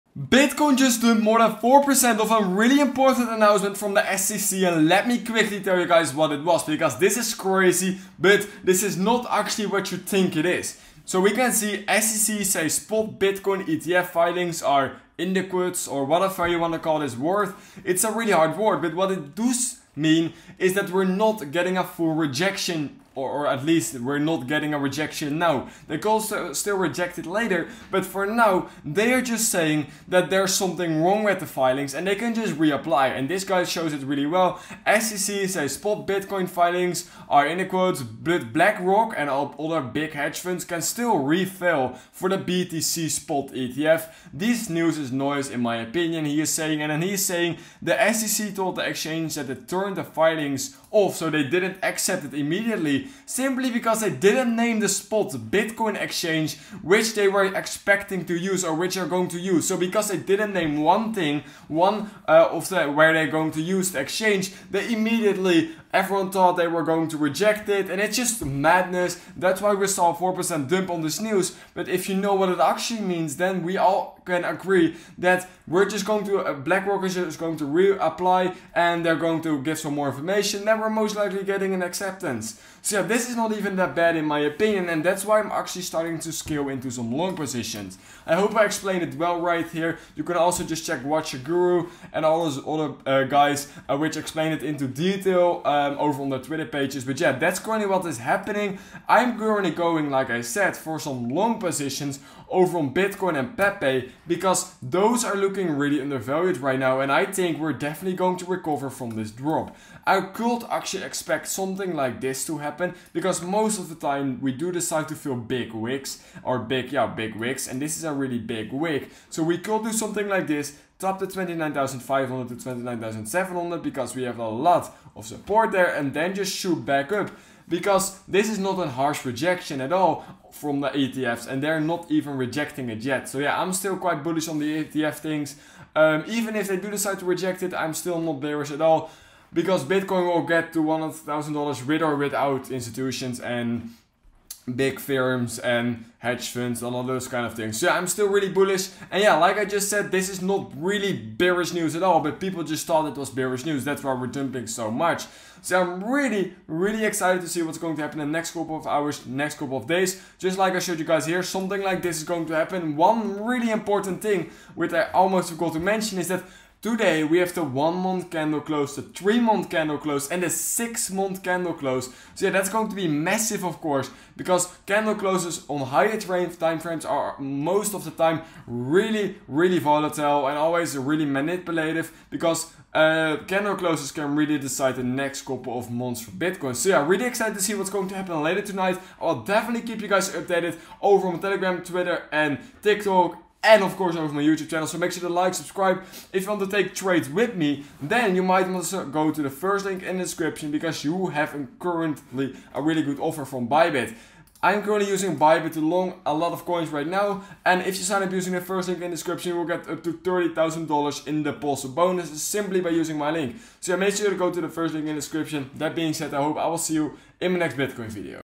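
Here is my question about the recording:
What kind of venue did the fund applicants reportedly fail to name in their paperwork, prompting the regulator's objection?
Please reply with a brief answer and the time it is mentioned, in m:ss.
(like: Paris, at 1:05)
spot Bitcoin exchange, at 0:54.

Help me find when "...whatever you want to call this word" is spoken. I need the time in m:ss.
0:16.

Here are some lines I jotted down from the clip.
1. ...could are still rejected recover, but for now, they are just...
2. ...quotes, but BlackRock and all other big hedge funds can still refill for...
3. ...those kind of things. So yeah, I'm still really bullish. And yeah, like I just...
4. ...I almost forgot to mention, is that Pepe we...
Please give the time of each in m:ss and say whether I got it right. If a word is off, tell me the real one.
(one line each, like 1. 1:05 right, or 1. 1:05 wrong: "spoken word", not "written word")
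1. 0:25 wrong: "later", not "recover"
2. 0:37 right
3. 2:27 right
4. 2:44 wrong: "Today", not "Pepe".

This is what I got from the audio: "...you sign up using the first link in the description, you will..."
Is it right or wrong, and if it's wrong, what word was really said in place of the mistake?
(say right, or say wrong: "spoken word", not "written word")
right.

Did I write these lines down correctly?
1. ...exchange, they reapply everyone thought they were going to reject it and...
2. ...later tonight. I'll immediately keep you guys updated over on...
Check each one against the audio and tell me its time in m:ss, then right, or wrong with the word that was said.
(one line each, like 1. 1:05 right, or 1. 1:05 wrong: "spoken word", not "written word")
1. 1:03 wrong: "immediately", not "reapply"
2. 3:08 wrong: "definitely", not "immediately".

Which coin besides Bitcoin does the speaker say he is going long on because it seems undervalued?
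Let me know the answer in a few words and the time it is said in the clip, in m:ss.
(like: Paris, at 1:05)
Pepe, at 1:43.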